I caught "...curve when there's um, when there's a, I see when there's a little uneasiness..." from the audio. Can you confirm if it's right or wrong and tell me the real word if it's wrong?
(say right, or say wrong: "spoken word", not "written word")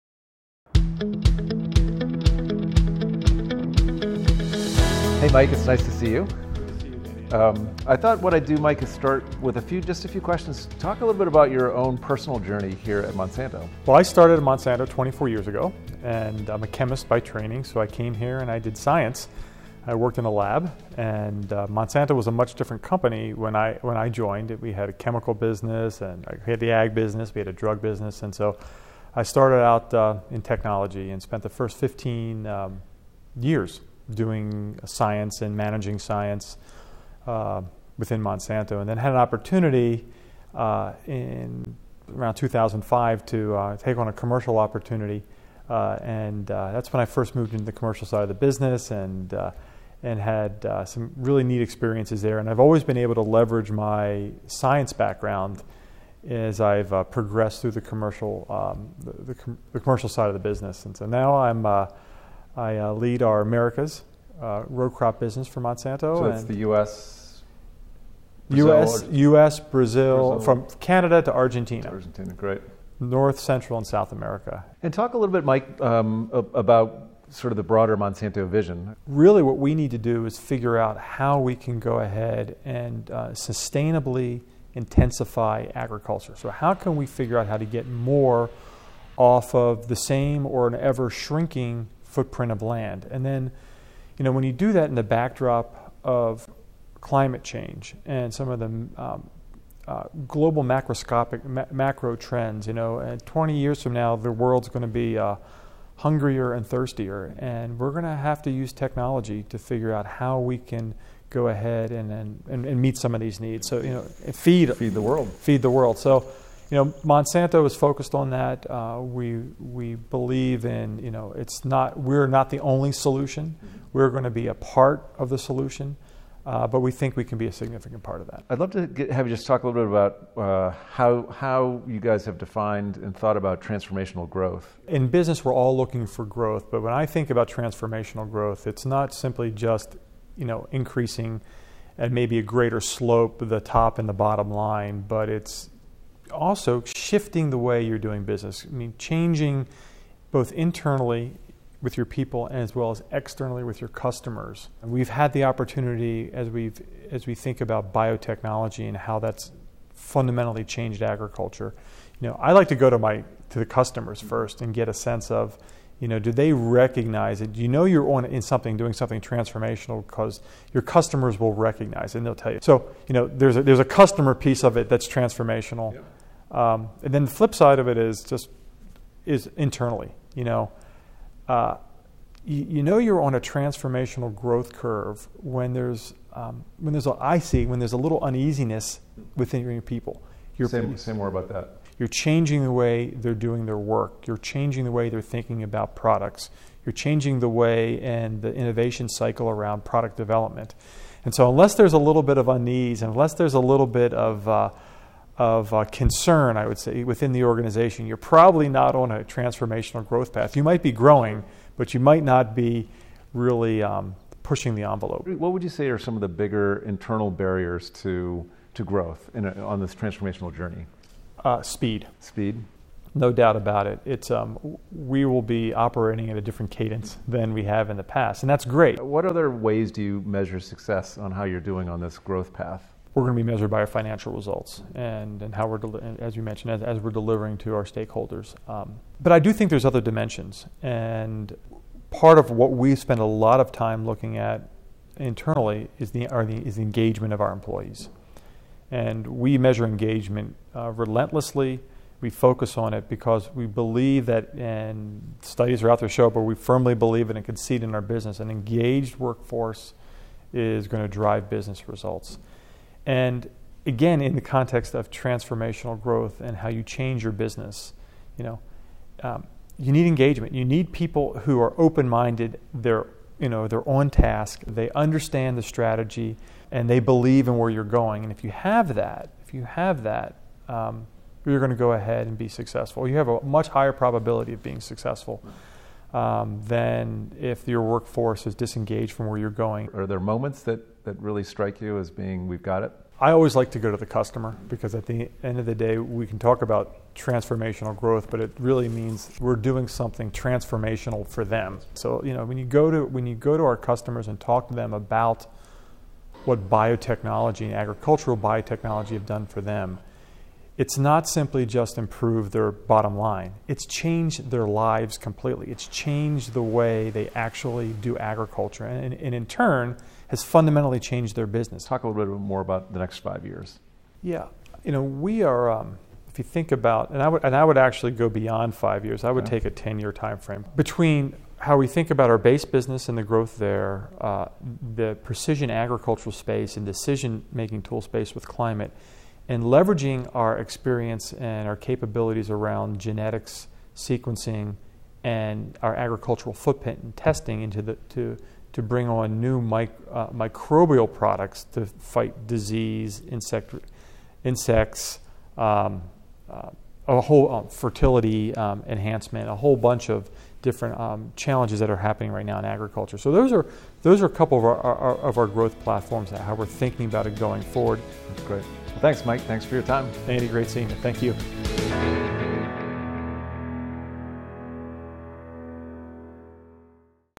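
right.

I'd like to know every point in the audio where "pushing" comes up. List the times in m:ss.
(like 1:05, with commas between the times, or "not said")
3:34.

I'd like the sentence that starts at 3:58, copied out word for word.
Um, but I do think there's other dimensions.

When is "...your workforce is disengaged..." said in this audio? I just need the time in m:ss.
4:47.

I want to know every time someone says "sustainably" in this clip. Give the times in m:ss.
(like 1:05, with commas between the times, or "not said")
1:23.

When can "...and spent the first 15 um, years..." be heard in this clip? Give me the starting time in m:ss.
0:31.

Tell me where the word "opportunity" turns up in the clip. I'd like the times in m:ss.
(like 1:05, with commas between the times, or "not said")
0:39, 0:44, 2:35.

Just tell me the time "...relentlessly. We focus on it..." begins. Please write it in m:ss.
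4:10.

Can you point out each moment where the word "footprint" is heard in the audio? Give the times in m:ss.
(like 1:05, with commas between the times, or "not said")
1:32, 5:46.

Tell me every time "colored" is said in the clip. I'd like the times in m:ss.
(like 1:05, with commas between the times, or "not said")
not said.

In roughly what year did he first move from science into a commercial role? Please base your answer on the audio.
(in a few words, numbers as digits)
2005.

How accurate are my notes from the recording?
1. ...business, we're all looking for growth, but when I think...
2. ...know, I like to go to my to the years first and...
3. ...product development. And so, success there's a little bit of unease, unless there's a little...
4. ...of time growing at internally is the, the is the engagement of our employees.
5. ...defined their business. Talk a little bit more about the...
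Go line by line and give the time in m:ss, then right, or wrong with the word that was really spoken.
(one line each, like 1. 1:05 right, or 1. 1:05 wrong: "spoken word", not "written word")
1. 2:15 right
2. 2:42 wrong: "customers", not "years"
3. 3:19 wrong: "unless", not "success"
4. 4:03 wrong: "looking", not "growing"
5. 5:20 wrong: "changed", not "defined".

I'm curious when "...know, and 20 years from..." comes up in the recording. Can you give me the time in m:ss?
1:42.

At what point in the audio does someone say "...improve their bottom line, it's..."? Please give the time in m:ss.
5:11.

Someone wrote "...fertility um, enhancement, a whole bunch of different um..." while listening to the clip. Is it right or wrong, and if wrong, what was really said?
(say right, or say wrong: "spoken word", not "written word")
right.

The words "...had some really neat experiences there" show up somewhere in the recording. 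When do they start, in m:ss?
0:50.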